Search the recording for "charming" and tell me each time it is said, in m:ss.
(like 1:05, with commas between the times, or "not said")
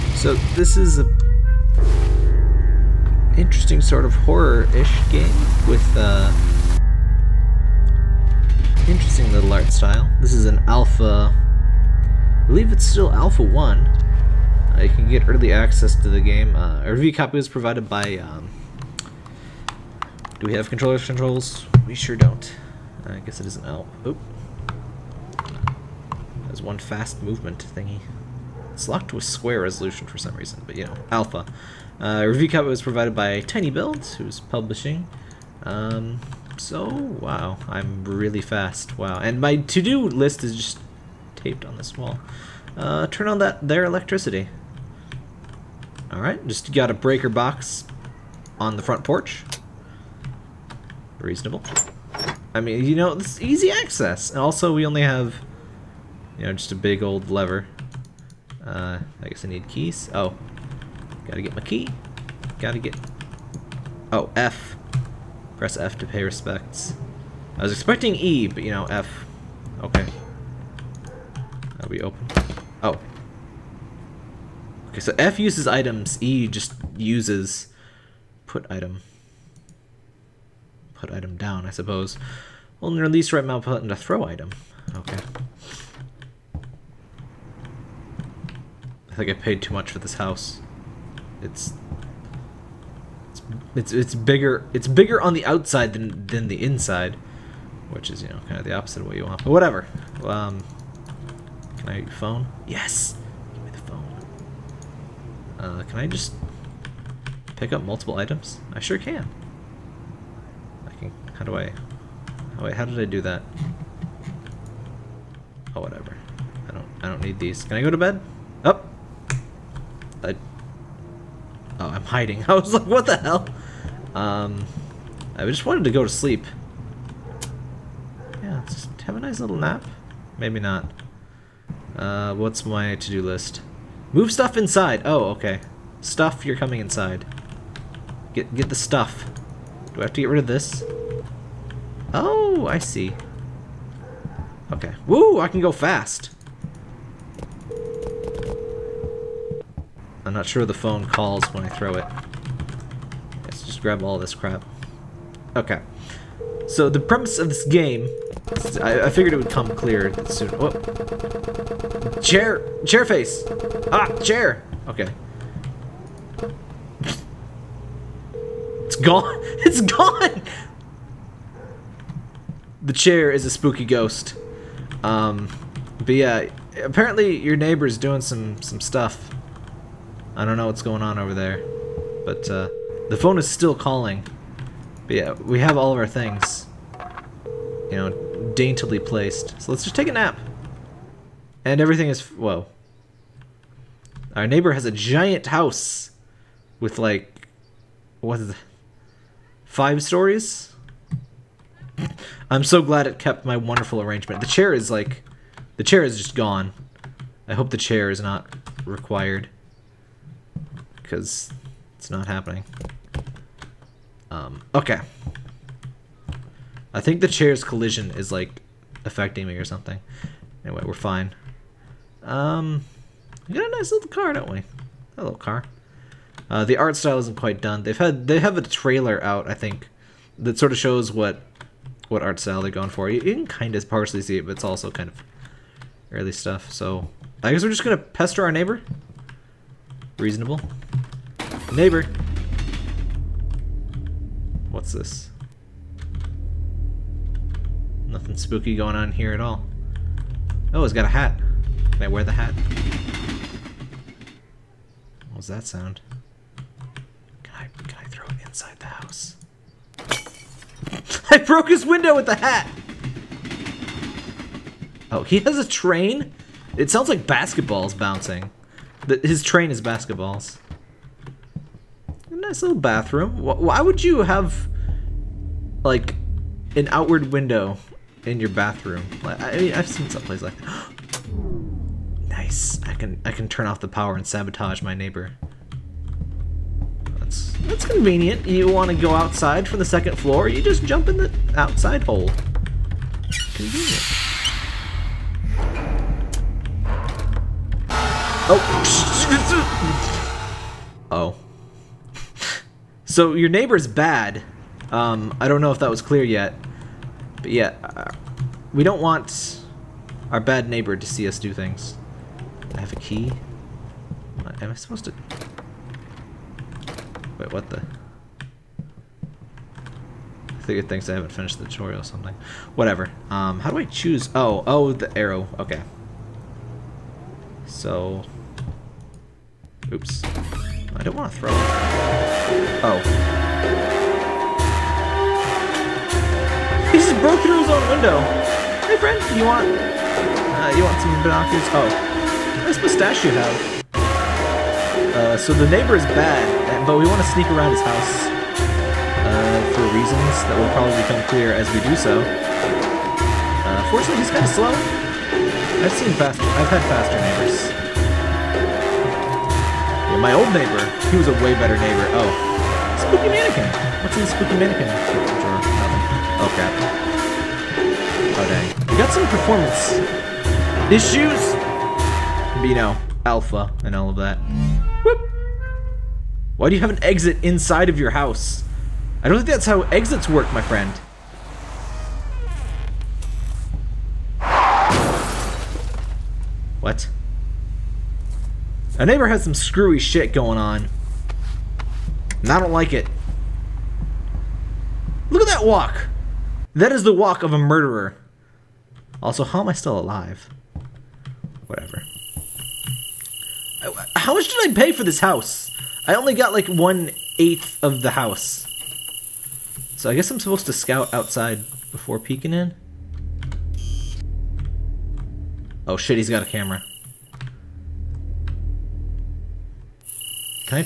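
not said.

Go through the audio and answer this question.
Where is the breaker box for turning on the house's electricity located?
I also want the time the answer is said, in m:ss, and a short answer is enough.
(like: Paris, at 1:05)
The front porch, at 0:48.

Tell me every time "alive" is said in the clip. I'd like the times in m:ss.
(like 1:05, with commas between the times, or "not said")
6:39.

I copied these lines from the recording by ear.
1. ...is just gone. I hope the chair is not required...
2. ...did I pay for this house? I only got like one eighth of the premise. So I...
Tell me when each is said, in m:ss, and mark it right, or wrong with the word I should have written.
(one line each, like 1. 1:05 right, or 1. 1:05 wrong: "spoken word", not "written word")
1. 3:26 right
2. 6:44 wrong: "house", not "premise".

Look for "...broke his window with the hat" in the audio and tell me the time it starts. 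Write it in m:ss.
4:21.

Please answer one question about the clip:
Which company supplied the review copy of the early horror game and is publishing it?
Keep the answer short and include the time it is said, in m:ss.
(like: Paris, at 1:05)
Tiny Builds, at 0:33.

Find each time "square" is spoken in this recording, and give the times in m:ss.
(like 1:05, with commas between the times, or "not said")
0:29.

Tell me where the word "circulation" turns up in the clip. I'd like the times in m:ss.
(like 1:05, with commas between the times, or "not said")
not said.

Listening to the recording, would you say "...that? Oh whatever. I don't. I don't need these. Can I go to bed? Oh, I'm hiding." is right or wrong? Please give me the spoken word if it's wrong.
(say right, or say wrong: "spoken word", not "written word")
right.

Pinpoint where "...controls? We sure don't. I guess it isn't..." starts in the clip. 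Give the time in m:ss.
0:20.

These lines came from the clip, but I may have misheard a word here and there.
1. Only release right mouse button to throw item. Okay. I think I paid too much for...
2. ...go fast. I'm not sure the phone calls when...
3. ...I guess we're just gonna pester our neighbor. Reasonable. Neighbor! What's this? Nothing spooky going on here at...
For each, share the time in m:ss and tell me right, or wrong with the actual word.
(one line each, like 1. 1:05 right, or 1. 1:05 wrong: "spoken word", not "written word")
1. 1:22 right
2. 2:25 right
3. 3:57 right.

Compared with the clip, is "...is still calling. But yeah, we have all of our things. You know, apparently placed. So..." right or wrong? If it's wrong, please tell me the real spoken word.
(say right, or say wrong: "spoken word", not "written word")
wrong: "daintily", not "apparently".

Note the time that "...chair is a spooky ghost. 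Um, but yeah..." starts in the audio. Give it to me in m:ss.
2:52.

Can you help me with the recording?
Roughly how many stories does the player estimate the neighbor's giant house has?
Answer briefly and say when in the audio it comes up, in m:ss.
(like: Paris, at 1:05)
5, at 3:19.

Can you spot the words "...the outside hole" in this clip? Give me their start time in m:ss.
4:51.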